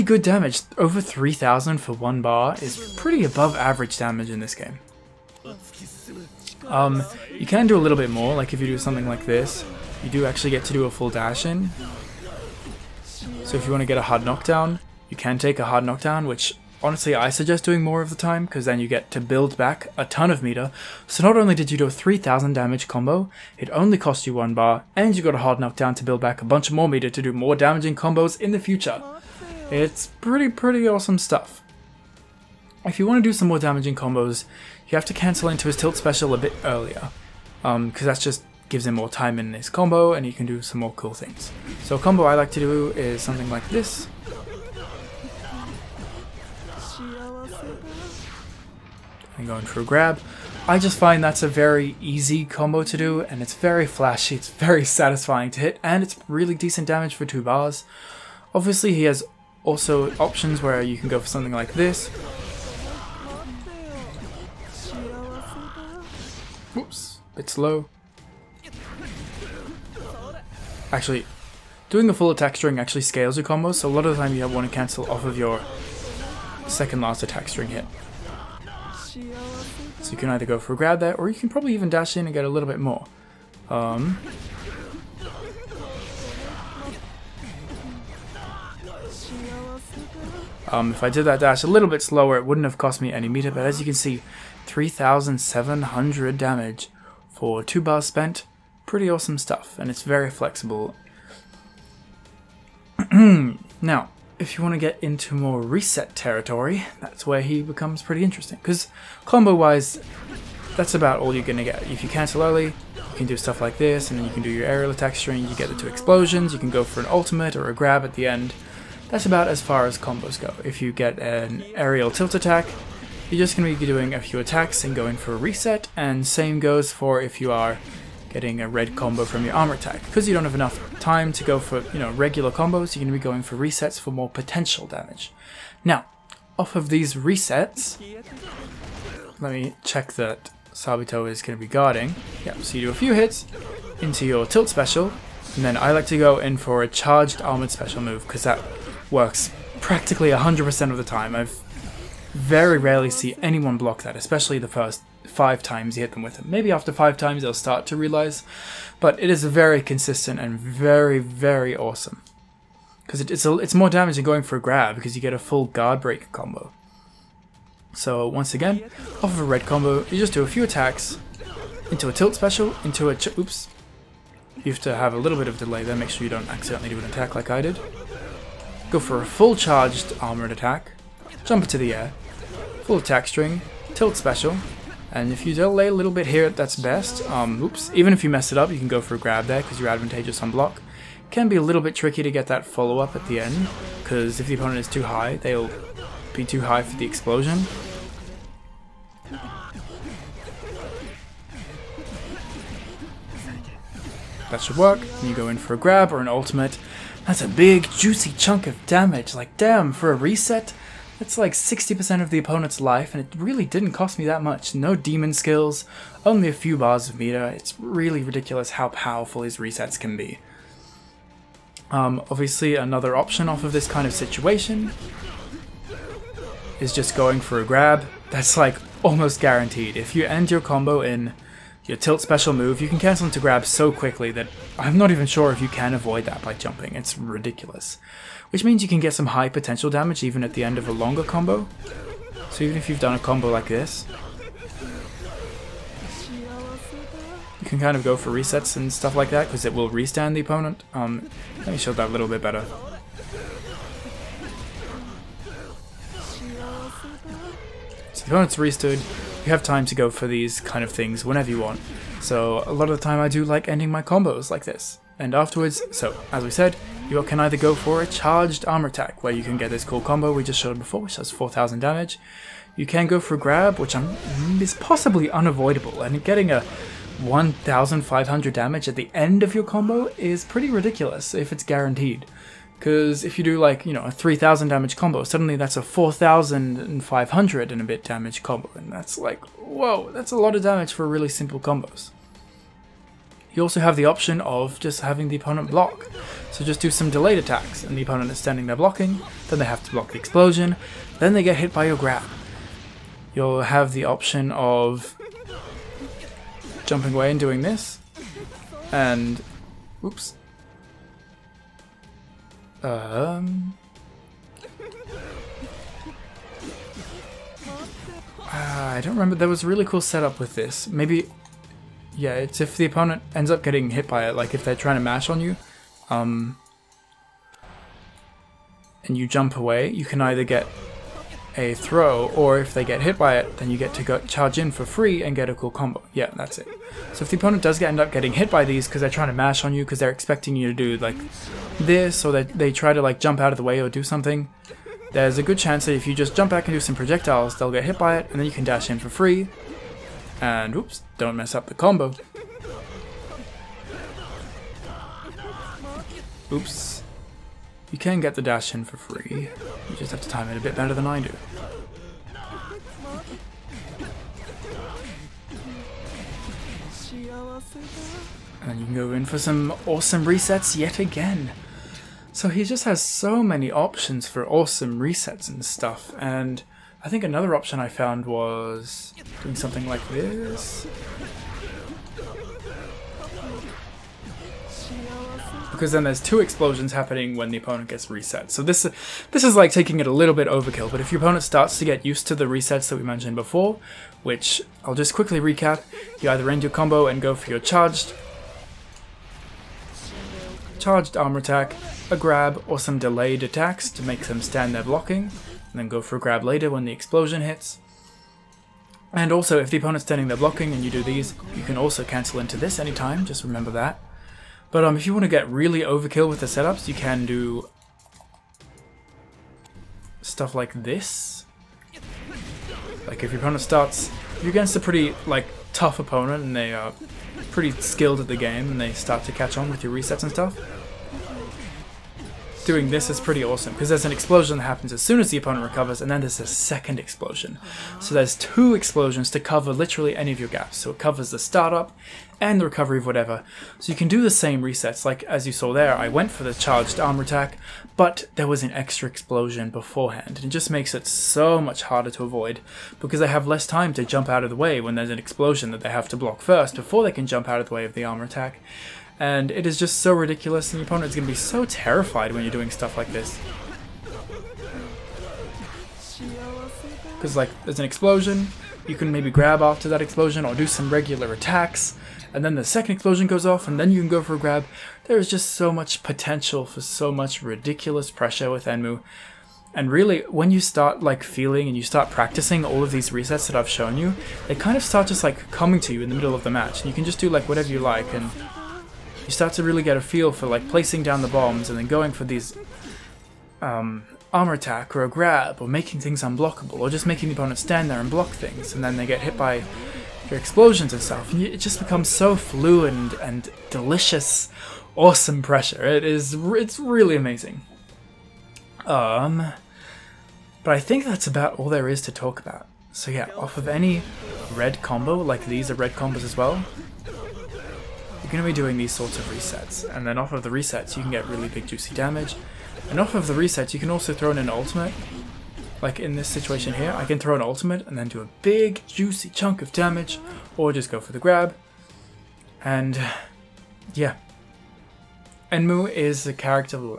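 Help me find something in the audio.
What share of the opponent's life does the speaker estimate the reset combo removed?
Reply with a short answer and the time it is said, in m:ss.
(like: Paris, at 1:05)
60%, at 3:31.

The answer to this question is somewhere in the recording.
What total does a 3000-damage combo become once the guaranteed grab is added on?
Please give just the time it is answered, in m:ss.
4:45.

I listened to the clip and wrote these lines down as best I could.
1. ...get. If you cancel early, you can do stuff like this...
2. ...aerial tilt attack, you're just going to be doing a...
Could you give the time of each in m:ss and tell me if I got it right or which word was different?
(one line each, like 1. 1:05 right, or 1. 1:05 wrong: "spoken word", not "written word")
1. 1:51 right
2. 2:01 right.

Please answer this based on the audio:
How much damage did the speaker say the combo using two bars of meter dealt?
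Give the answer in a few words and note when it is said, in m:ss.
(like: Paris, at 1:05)
3,700, at 1:34.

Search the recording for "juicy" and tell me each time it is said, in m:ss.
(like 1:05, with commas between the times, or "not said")
3:27, 8:41, 8:48.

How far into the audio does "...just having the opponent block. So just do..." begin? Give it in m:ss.
4:54.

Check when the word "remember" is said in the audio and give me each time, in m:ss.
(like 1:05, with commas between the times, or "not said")
5:19, 6:53.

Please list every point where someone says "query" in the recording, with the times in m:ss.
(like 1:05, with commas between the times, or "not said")
not said.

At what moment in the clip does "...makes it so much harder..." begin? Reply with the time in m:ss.
7:30.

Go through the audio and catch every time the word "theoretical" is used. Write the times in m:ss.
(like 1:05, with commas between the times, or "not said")
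not said.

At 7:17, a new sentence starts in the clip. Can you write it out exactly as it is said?
So there's two explosions to cover literally any of your gaps.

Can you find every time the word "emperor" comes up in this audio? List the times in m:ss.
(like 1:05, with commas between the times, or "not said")
not said.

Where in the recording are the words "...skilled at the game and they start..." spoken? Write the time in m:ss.
7:07.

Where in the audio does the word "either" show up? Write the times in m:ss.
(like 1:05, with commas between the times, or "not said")
1:20, 4:27, 5:30, 6:36.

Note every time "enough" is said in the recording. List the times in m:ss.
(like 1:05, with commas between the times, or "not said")
2:10.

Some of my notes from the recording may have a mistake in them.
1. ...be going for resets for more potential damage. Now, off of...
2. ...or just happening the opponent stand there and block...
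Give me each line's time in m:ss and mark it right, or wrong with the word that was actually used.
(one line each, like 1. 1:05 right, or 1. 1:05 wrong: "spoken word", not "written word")
1. 2:13 right
2. 8:16 wrong: "making", not "happening".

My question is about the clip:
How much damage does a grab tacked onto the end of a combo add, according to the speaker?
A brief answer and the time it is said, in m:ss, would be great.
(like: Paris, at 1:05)
1500, at 4:37.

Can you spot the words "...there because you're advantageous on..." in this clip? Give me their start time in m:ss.
3:09.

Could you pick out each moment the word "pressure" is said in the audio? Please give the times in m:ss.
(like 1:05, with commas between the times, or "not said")
7:58, 8:25.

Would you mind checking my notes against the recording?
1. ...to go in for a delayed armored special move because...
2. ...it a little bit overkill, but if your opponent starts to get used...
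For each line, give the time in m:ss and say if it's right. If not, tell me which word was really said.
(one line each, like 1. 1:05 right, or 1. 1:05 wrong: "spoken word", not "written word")
1. 2:26 wrong: "charged", not "delayed"
2. 6:29 right.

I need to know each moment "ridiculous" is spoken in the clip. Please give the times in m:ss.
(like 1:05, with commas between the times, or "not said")
3:38, 3:57, 4:40, 7:40, 7:57.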